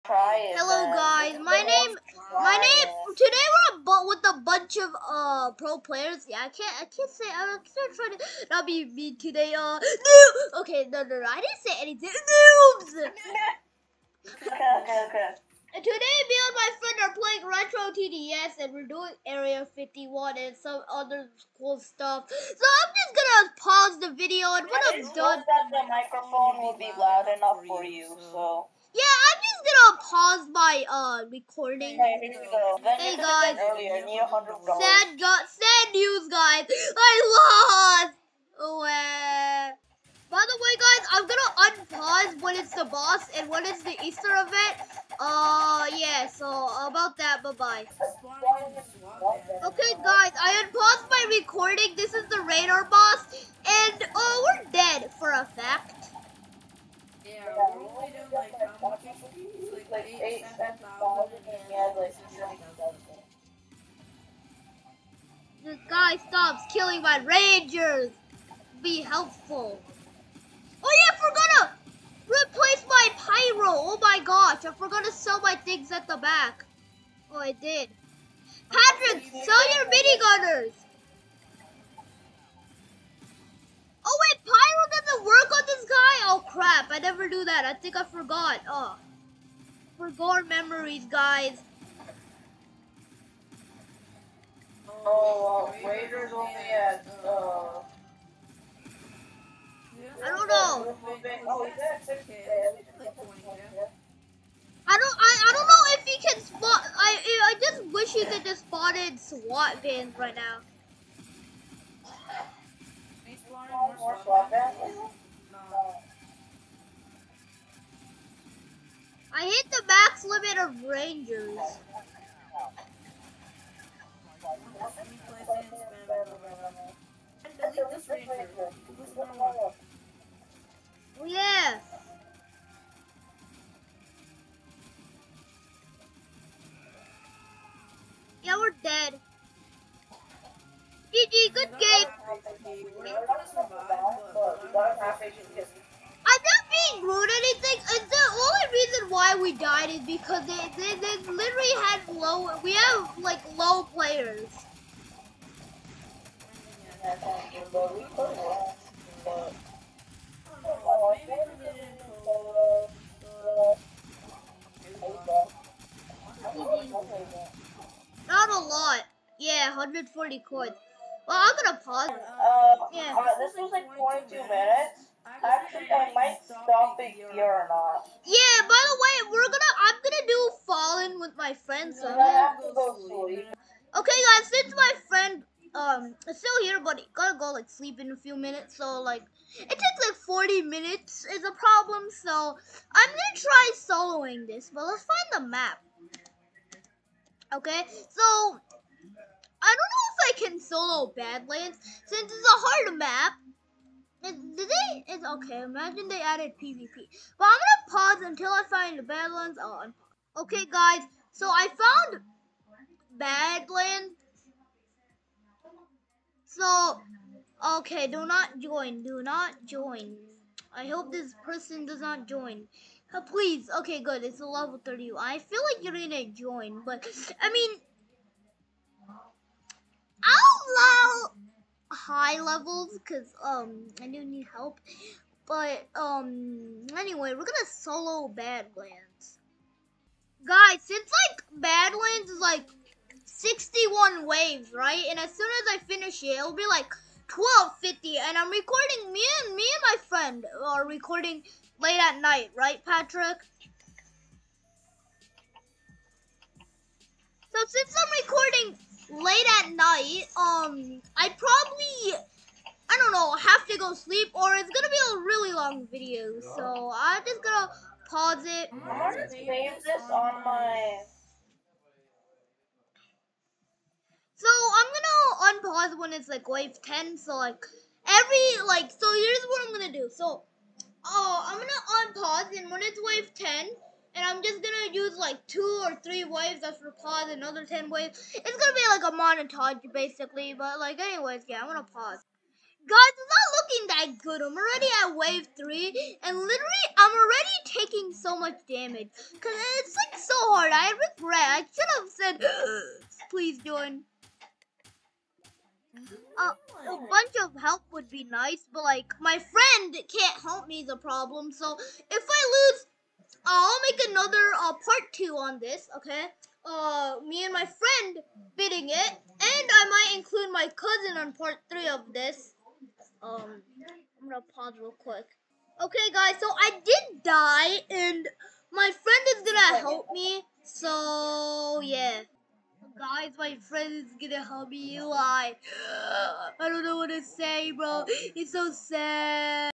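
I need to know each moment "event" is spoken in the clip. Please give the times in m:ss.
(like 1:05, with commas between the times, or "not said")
0:44.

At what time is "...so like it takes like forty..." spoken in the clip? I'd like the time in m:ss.
3:08.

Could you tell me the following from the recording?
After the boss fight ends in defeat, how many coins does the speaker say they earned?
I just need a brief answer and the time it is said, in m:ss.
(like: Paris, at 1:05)
140, at 2:49.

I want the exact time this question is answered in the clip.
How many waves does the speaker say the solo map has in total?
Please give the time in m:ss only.
4:03.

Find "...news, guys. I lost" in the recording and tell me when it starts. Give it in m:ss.
0:35.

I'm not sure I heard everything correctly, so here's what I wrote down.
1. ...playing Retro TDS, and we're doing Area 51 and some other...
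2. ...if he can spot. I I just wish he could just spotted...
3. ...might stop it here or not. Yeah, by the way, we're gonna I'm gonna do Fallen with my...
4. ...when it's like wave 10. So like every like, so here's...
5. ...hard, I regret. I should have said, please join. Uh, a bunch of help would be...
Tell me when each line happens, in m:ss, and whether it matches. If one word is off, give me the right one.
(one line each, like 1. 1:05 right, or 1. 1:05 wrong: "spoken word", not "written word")
1. 0:17 right
2. 1:45 right
3. 2:56 right
4. 4:35 right
5. 5:00 right.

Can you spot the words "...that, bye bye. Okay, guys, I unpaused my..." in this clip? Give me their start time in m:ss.
0:47.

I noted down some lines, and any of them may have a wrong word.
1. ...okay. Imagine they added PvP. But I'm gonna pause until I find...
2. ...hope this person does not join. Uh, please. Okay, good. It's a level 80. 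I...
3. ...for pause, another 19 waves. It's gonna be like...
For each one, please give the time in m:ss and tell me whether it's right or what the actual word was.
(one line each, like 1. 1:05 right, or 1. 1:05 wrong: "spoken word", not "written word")
1. 3:25 right
2. 3:40 wrong: "30", not "80"
3. 4:46 wrong: "10", not "19".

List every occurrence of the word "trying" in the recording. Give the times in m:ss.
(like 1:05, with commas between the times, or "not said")
0:07.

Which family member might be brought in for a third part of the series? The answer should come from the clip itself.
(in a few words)
cousin.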